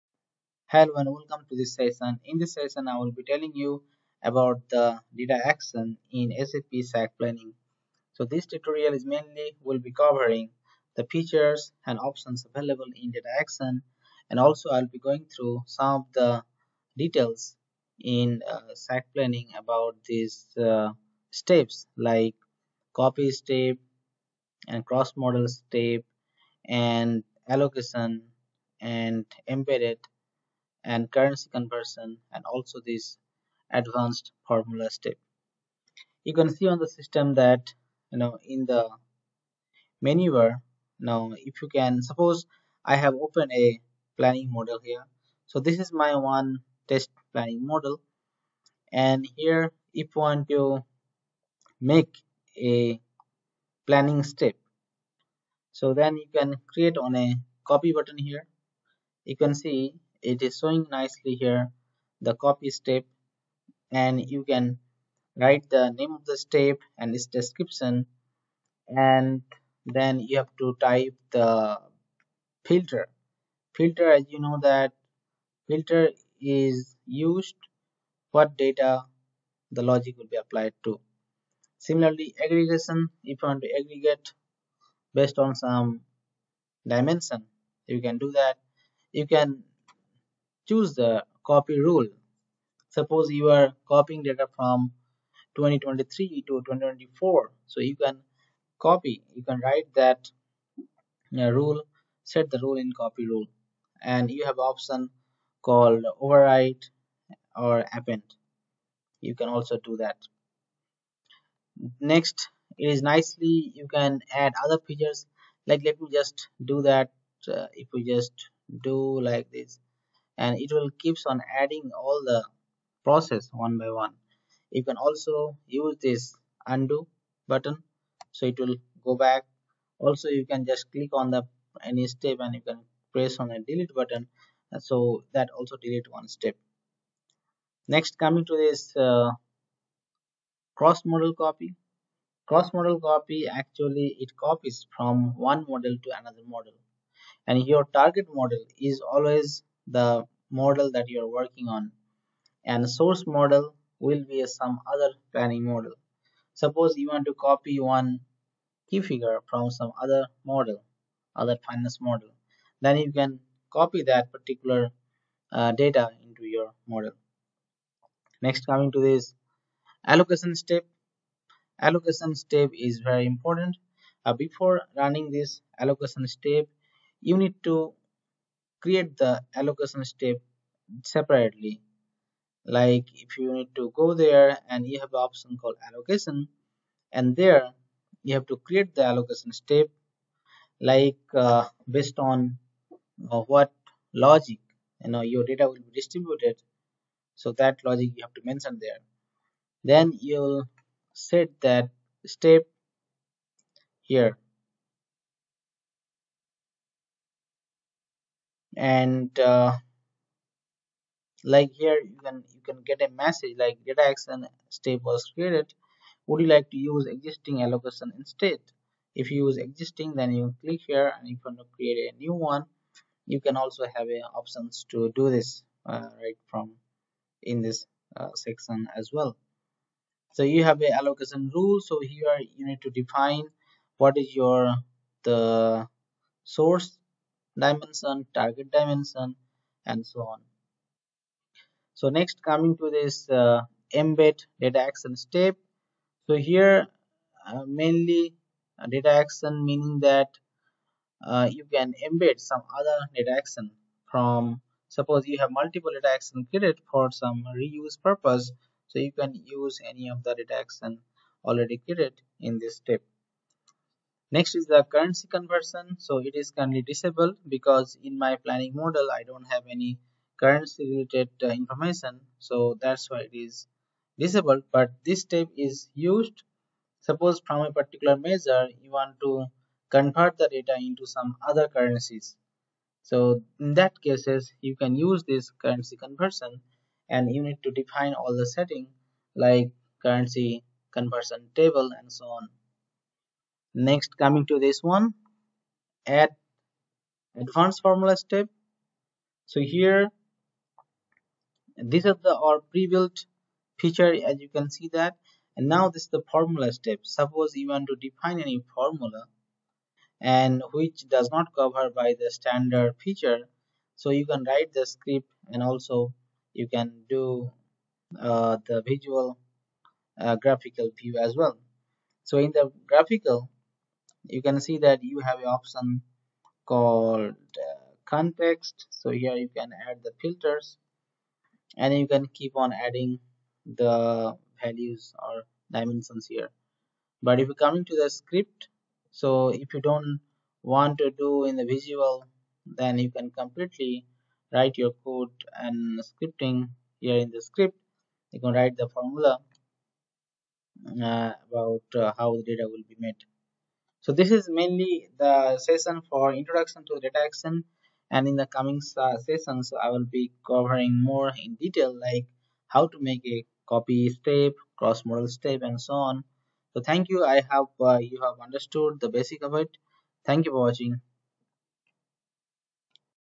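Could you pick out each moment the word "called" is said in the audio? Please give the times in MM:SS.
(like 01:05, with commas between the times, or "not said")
01:45, 03:05, 05:26.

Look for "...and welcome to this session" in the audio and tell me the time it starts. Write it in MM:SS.
00:00.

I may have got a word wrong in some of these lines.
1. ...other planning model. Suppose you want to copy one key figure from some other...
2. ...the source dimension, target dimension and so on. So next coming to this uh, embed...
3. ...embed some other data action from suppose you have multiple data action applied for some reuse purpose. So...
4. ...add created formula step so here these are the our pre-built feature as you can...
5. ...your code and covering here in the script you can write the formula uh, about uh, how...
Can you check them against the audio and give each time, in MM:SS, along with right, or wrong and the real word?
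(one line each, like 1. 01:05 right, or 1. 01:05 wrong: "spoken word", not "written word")
1. 02:34 right
2. 03:55 right
3. 04:12 wrong: "created", not "applied"
4. 04:56 wrong: "advanced", not "created"
5. 05:44 wrong: "scripting", not "covering".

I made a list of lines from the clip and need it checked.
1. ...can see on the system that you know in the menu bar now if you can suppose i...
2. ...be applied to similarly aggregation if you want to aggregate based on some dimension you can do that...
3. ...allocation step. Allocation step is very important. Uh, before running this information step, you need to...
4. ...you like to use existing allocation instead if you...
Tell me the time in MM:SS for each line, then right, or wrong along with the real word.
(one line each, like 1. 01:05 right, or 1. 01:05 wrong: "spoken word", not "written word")
1. 00:36 right
2. 01:20 right
3. 02:50 wrong: "allocation", not "information"
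4. 03:36 right.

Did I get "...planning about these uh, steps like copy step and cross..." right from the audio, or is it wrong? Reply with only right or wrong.
right.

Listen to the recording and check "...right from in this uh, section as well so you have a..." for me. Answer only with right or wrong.
right.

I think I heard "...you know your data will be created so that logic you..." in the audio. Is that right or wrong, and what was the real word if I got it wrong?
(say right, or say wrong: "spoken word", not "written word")
wrong: "distributed", not "created".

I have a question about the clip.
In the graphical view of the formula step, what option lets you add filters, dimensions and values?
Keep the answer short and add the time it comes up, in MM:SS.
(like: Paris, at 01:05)
context, at 05:28.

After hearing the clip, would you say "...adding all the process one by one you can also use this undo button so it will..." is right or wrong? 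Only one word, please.
right.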